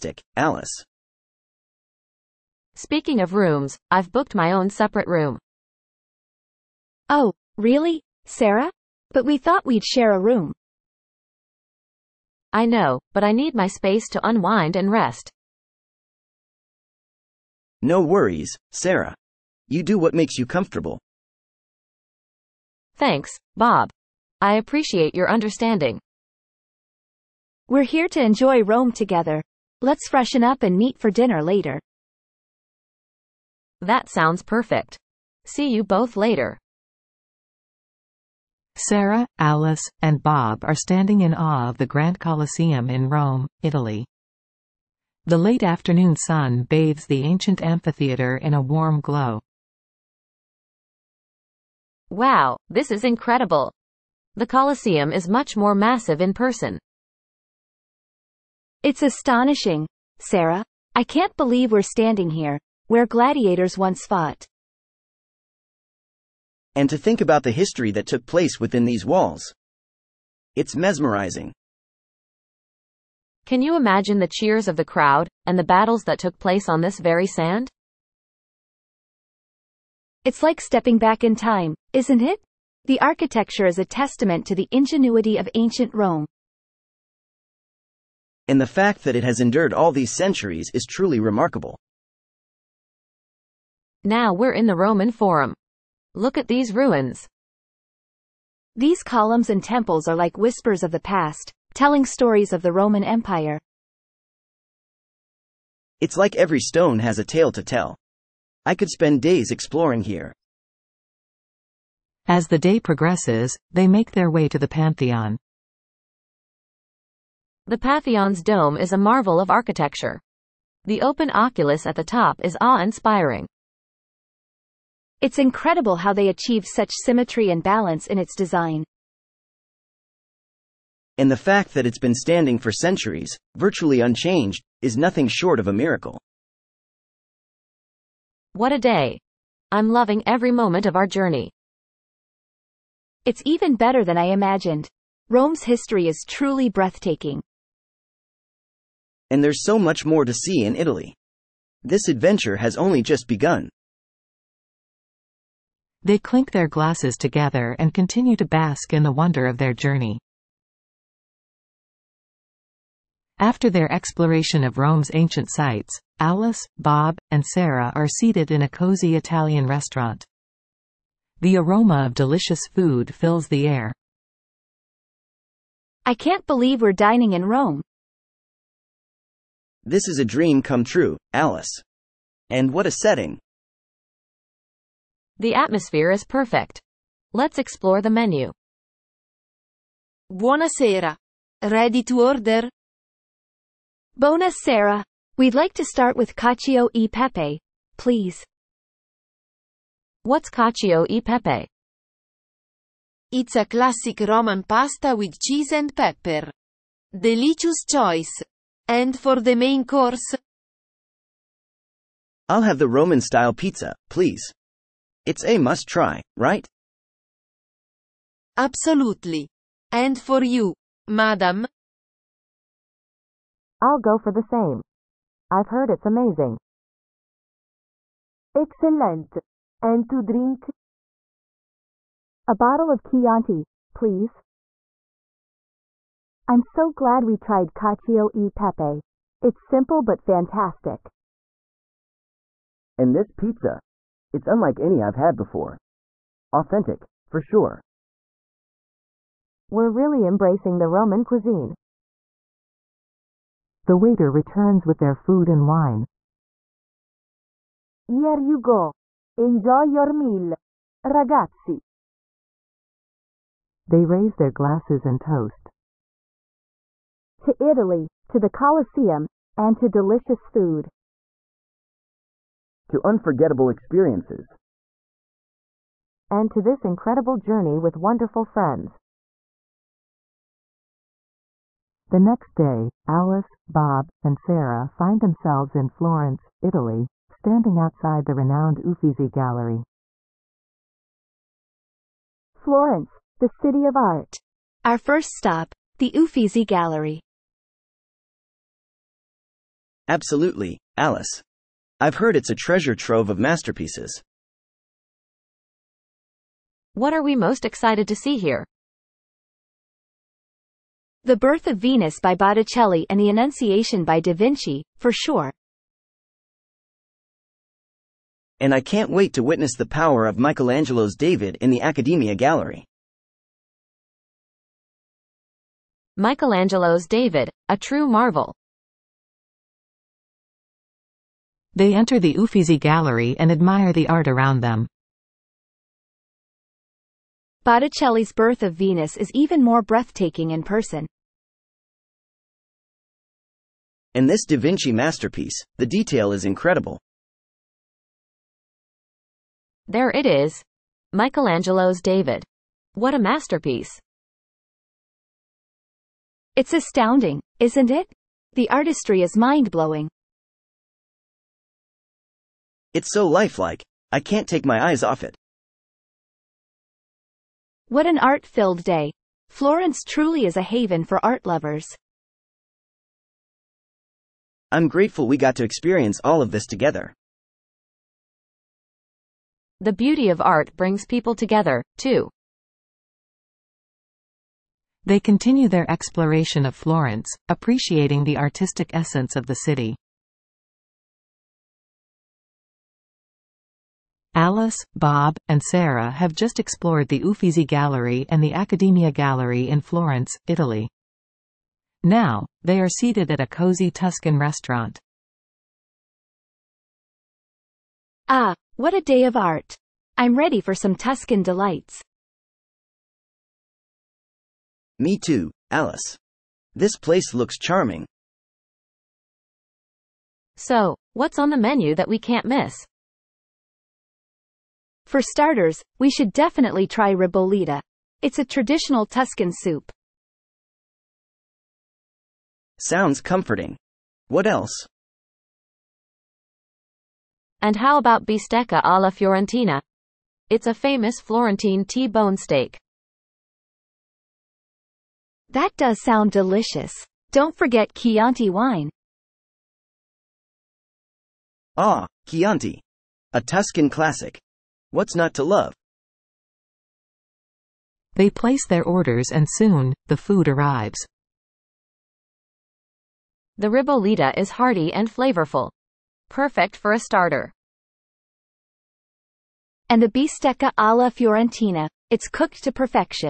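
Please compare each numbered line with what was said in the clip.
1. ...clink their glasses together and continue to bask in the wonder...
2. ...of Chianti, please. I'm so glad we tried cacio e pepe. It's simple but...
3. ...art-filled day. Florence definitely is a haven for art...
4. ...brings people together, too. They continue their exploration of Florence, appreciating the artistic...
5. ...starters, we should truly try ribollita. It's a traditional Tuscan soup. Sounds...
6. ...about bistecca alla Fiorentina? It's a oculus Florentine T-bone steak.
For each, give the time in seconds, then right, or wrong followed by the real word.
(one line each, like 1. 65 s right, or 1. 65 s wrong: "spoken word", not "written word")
1. 156 s right
2. 232 s right
3. 368 s wrong: "truly", not "definitely"
4. 380 s right
5. 425 s wrong: "definitely", not "truly"
6. 437 s wrong: "famous", not "oculus".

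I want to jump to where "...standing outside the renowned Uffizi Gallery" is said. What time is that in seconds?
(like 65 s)
287 s.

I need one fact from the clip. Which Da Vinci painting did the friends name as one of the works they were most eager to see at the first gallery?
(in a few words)
The Annunciation.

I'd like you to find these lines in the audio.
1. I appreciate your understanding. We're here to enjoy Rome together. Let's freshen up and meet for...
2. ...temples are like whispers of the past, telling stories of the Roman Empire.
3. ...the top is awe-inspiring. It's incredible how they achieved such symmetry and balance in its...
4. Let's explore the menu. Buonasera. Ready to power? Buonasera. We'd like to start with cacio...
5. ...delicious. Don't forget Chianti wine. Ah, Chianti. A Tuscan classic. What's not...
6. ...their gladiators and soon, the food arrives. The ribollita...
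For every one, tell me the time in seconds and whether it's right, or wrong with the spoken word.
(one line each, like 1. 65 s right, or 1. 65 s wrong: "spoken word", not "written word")
1. 24 s right
2. 99 s right
3. 121 s right
4. 187 s wrong: "order", not "power"
5. 446 s right
6. 458 s wrong: "orders", not "gladiators".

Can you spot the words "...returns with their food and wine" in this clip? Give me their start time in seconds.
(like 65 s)
254 s.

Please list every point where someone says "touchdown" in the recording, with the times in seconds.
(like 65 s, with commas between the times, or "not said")
not said.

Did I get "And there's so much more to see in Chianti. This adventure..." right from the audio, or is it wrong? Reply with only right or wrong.
wrong.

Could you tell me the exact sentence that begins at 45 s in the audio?
The late afternoon sun bathes the ancient amphitheater in a warm glow.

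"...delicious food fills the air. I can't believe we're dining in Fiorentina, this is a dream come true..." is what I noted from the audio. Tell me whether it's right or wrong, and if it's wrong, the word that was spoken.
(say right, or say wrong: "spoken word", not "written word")
wrong: "Rome", not "Fiorentina".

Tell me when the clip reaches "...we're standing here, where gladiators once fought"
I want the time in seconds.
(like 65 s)
61 s.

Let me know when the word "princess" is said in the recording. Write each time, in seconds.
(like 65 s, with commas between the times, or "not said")
not said.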